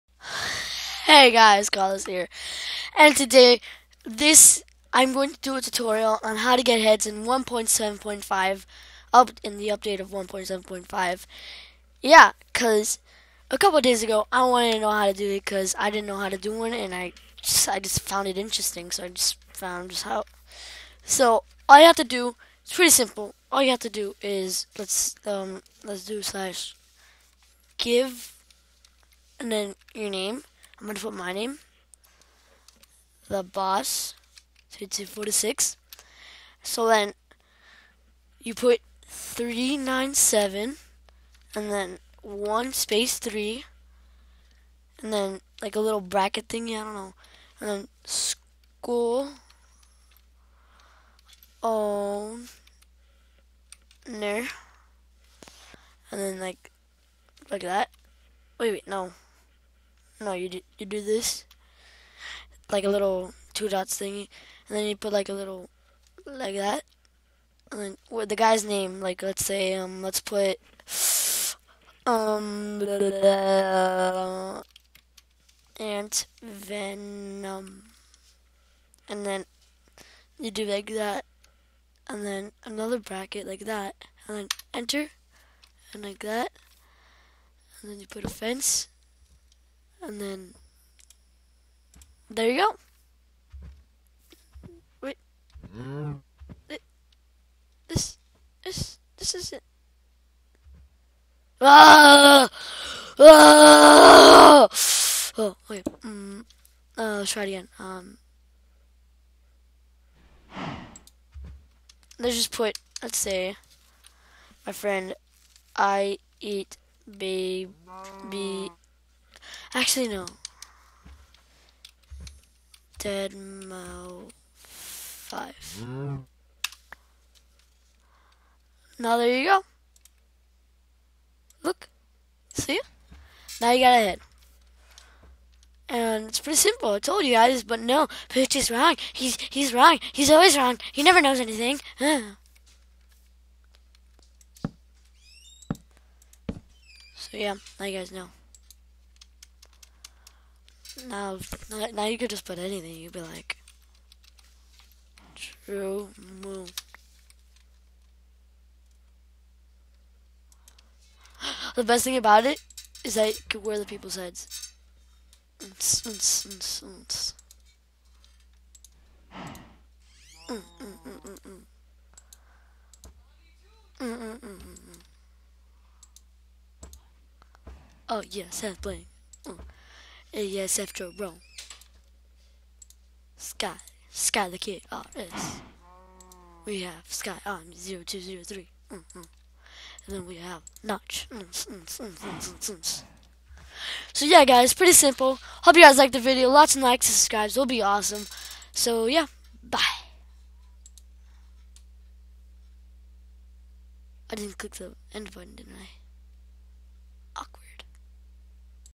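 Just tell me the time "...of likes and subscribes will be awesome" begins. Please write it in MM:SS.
03:16.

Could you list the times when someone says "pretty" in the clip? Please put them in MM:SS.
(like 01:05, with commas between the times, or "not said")
00:22, 02:16, 03:14.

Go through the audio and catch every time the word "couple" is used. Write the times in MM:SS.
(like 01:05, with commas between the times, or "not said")
00:13.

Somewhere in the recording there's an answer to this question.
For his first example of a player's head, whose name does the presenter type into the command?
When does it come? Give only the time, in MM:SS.
01:15.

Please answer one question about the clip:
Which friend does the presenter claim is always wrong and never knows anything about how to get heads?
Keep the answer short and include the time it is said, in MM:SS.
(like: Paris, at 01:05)
Pooch, at 02:18.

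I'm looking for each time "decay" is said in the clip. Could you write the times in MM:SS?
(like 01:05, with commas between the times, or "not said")
not said.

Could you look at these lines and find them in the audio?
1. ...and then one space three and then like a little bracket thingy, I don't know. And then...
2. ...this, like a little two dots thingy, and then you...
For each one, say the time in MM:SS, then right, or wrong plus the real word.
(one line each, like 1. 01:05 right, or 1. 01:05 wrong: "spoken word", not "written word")
1. 00:41 right
2. 01:01 right.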